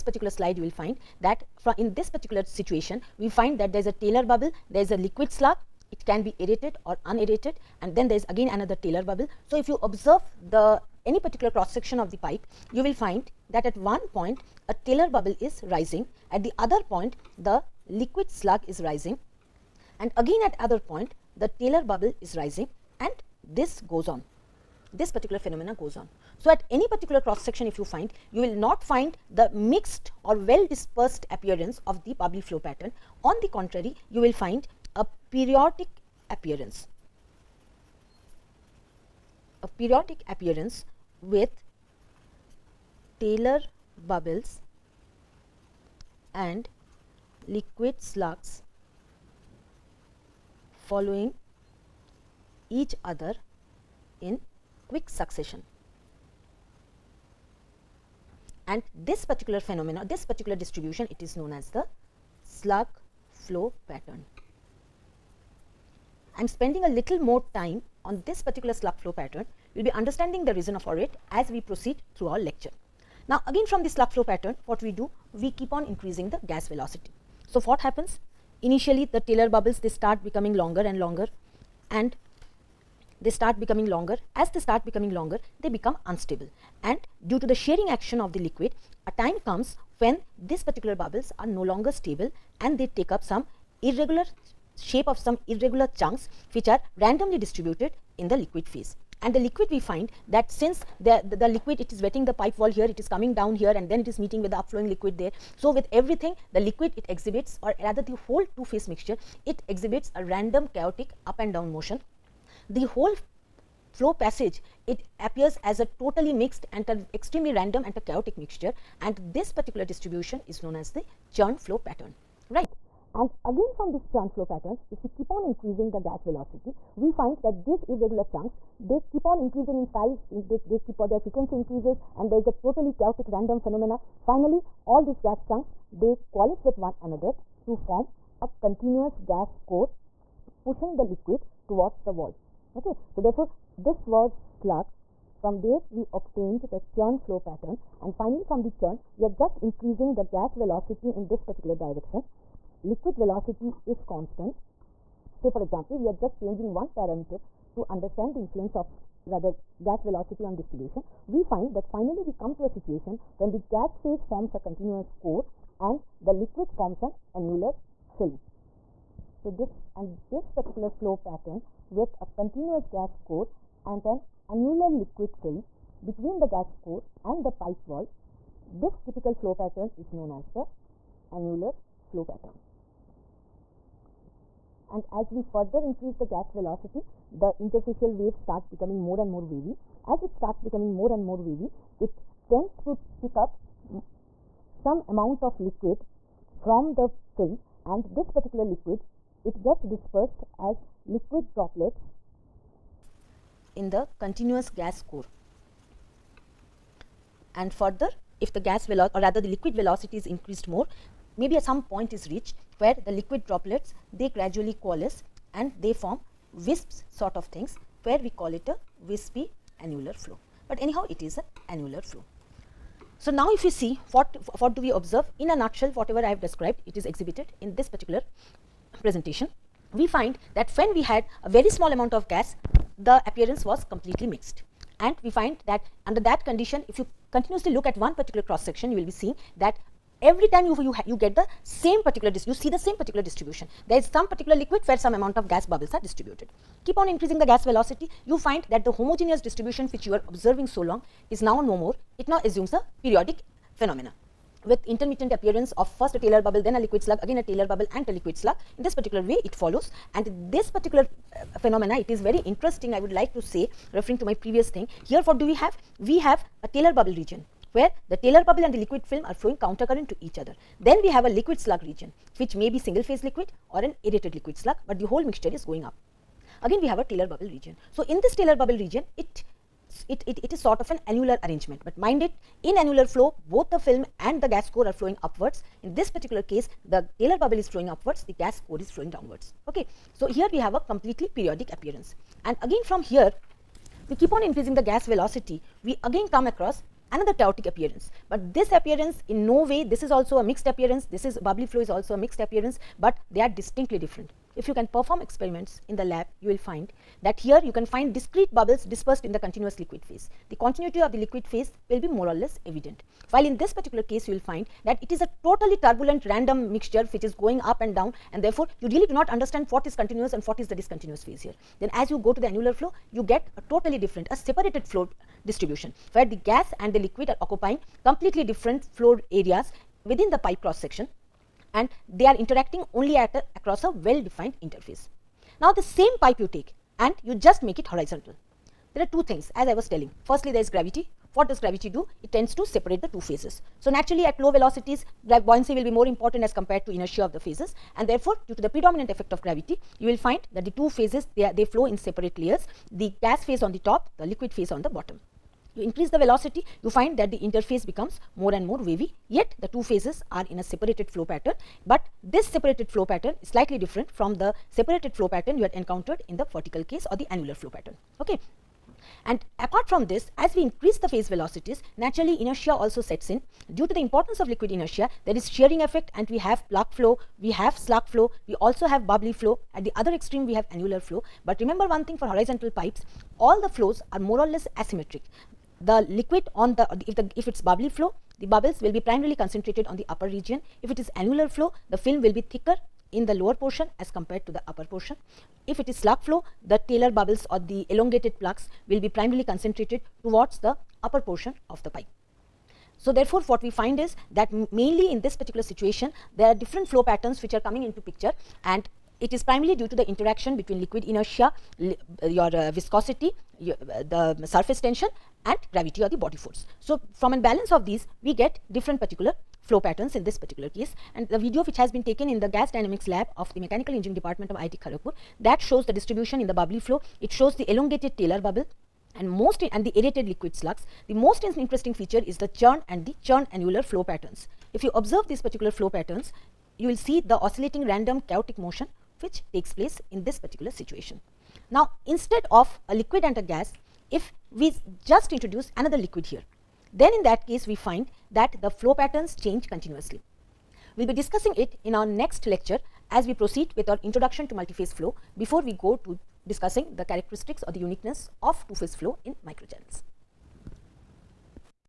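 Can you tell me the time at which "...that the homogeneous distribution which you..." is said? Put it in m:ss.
4:08.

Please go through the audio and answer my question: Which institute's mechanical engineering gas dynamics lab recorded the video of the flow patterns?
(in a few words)
IIT Kharagpur.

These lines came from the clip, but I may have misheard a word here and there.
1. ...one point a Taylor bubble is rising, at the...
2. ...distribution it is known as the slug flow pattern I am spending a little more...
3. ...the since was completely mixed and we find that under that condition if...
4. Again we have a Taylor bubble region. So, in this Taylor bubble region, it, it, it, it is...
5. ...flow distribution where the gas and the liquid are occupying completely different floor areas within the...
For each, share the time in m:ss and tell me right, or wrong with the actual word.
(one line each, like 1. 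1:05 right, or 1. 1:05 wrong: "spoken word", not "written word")
1. 0:13 right
2. 1:00 right
3. 3:52 wrong: "appearance", not "since"
4. 4:36 right
5. 5:24 right.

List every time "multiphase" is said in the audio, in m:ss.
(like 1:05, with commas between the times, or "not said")
7:34.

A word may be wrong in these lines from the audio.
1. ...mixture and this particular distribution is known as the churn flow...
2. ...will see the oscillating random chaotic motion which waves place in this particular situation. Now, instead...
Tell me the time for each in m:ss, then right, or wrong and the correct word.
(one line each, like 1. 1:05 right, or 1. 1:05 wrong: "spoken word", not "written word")
1. 1:58 right
2. 7:16 wrong: "takes", not "waves".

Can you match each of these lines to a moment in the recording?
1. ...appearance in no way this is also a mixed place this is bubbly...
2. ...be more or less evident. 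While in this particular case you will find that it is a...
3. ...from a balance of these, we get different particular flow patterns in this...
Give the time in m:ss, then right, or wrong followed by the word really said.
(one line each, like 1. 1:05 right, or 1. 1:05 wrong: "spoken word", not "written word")
1. 4:58 wrong: "appearance", not "place"
2. 5:11 right
3. 6:57 right.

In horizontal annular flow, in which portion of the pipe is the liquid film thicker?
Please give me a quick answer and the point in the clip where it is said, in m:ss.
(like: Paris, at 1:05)
lower portion, at 6:33.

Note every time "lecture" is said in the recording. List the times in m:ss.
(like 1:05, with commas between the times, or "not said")
1:12, 7:32.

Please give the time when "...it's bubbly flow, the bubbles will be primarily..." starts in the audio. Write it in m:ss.
6:27.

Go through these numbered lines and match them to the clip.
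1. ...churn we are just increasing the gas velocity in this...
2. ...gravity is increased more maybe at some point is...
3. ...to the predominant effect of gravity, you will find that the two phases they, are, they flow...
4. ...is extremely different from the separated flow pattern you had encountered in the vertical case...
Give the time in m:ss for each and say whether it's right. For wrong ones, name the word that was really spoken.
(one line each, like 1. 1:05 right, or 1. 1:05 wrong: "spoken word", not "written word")
1. 2:28 right
2. 3:29 wrong: "velocity", not "gravity"
3. 5:48 right
4. 6:03 wrong: "slightly", not "extremely".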